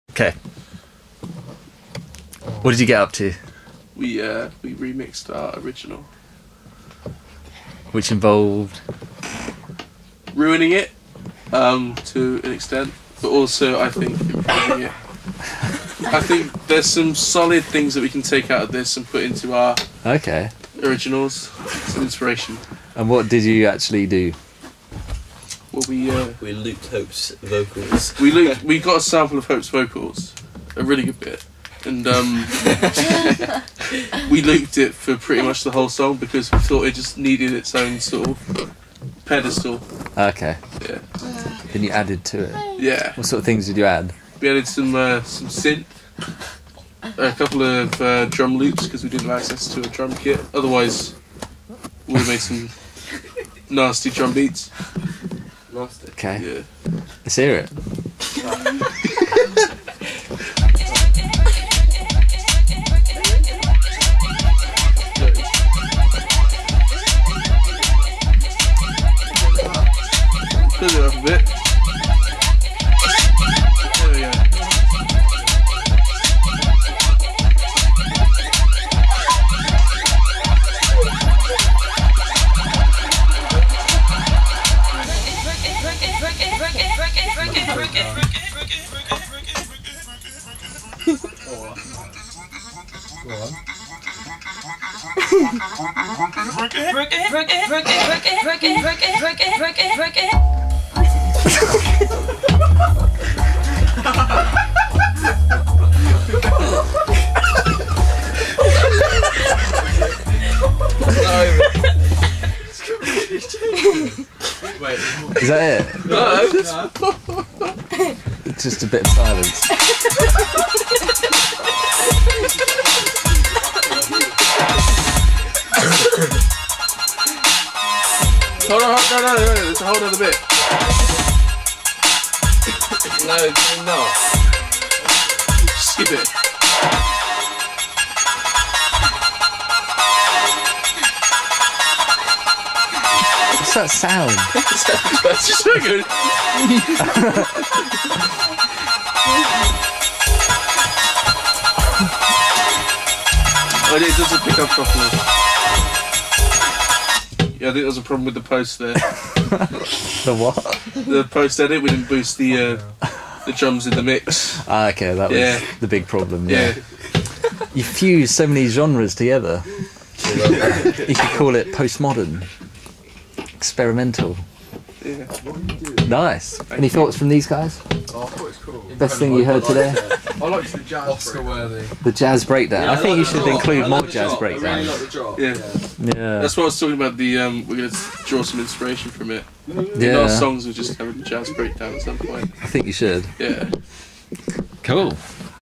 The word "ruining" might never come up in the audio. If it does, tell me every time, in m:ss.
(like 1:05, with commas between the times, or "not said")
0:10.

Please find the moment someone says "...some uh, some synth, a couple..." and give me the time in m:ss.
0:44.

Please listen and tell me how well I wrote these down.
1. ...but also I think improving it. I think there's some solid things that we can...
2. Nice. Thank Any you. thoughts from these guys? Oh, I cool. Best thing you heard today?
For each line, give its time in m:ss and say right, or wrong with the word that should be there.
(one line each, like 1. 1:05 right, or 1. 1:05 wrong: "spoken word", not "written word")
1. 0:13 right
2. 2:56 right.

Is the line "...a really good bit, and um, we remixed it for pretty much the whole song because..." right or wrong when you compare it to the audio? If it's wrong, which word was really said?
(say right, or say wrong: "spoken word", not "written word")
wrong: "looped", not "remixed".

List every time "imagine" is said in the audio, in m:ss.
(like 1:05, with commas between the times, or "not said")
not said.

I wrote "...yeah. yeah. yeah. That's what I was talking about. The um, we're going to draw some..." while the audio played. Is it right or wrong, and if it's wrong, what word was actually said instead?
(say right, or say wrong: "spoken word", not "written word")
right.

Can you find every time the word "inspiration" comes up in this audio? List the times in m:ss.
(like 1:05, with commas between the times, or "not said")
0:22, 3:08.